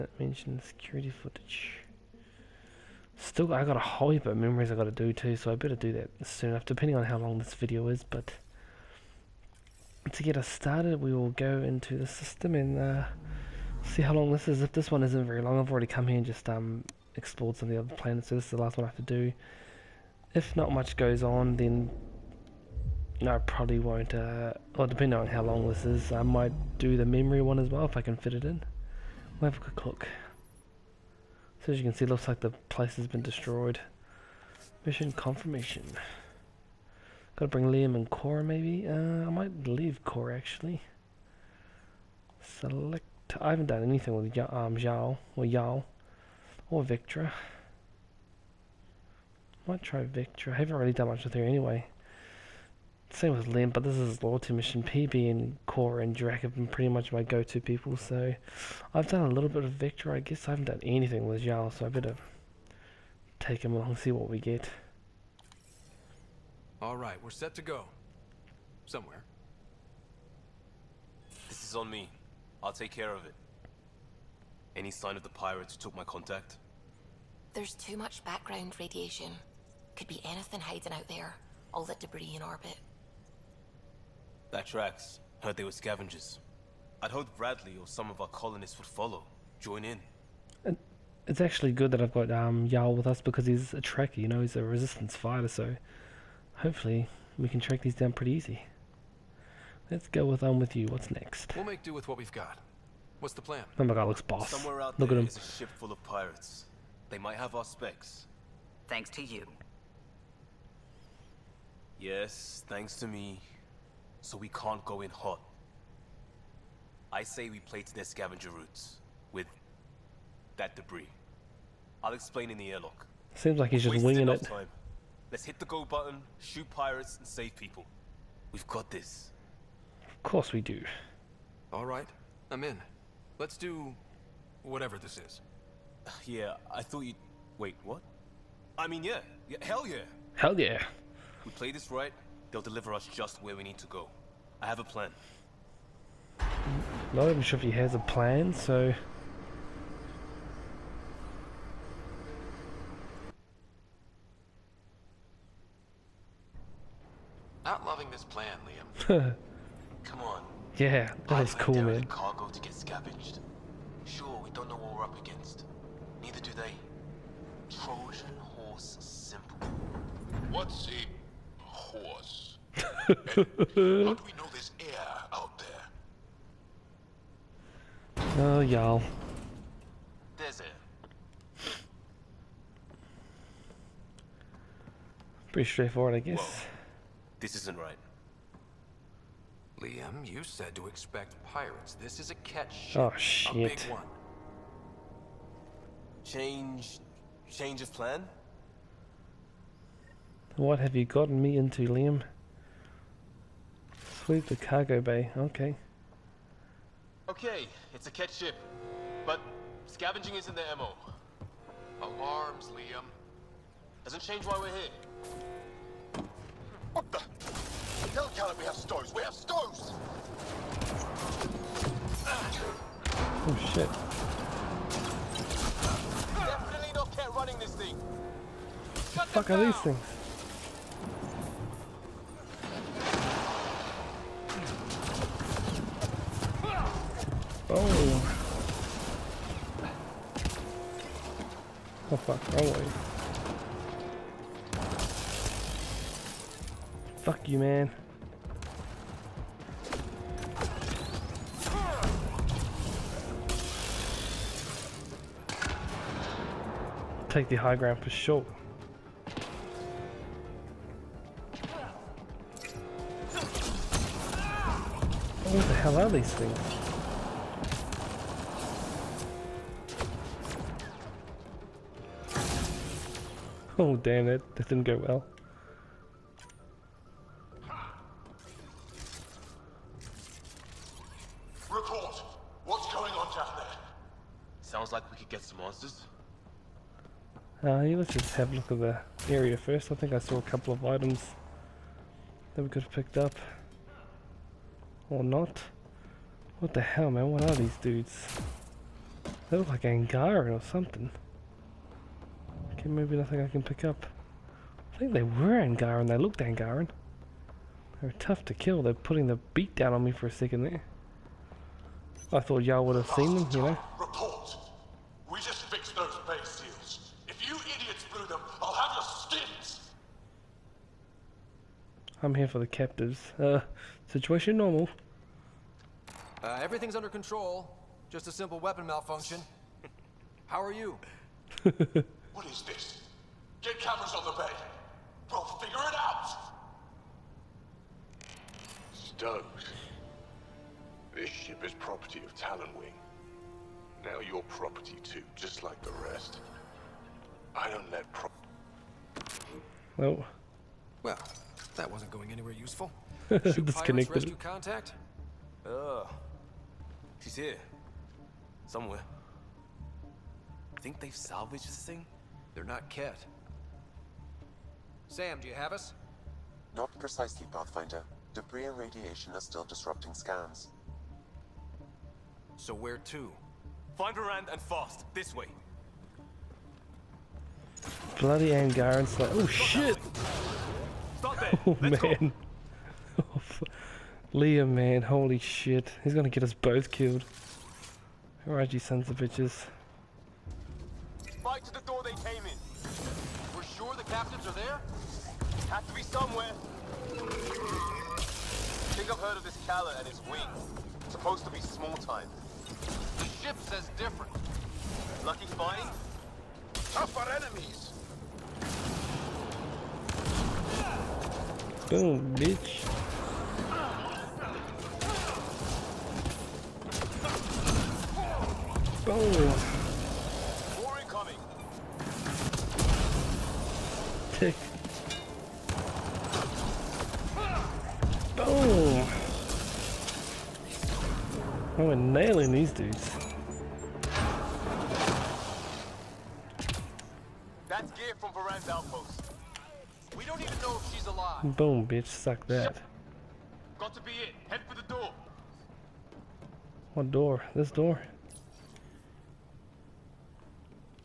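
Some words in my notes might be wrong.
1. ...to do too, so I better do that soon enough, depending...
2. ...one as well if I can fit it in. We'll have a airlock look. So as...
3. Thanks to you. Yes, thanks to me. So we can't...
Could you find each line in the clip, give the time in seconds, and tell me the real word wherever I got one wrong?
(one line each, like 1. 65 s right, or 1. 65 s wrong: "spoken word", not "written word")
1. 4 s right
2. 27 s wrong: "quick", not "airlock"
3. 108 s right.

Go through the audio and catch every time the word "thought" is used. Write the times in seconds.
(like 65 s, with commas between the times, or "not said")
136 s, 312 s.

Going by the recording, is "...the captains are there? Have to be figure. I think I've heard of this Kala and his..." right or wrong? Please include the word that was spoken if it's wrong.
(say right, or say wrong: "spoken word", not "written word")
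wrong: "somewhere", not "figure".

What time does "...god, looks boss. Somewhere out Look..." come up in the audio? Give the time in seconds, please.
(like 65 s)
103 s.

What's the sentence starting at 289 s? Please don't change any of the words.
I think I saw a couple of items that we could have picked up.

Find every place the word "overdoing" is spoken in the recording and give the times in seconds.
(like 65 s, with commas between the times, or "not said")
not said.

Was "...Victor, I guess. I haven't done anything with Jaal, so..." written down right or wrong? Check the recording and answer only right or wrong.
right.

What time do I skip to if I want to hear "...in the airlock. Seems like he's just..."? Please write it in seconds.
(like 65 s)
122 s.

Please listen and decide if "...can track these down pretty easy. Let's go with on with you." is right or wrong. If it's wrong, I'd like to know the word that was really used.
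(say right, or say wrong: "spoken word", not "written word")
right.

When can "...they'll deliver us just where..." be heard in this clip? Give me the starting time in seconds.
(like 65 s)
142 s.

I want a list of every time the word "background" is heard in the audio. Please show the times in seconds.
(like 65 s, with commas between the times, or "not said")
78 s.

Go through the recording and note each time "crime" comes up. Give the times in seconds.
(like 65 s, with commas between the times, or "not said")
not said.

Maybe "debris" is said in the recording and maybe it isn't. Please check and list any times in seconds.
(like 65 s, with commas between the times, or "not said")
81 s, 120 s, 368 s.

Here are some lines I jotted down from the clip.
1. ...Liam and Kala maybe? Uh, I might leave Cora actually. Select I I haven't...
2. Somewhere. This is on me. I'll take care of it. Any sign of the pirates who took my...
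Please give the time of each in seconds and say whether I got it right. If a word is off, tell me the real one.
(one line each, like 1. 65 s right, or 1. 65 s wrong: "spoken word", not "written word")
1. 37 s wrong: "Cora", not "Kala"
2. 68 s right.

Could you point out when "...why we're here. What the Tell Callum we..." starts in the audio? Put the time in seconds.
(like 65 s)
214 s.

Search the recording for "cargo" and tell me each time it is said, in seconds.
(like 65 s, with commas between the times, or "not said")
162 s, 204 s.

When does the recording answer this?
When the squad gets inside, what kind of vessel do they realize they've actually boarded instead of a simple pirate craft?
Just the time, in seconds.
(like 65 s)
192 s.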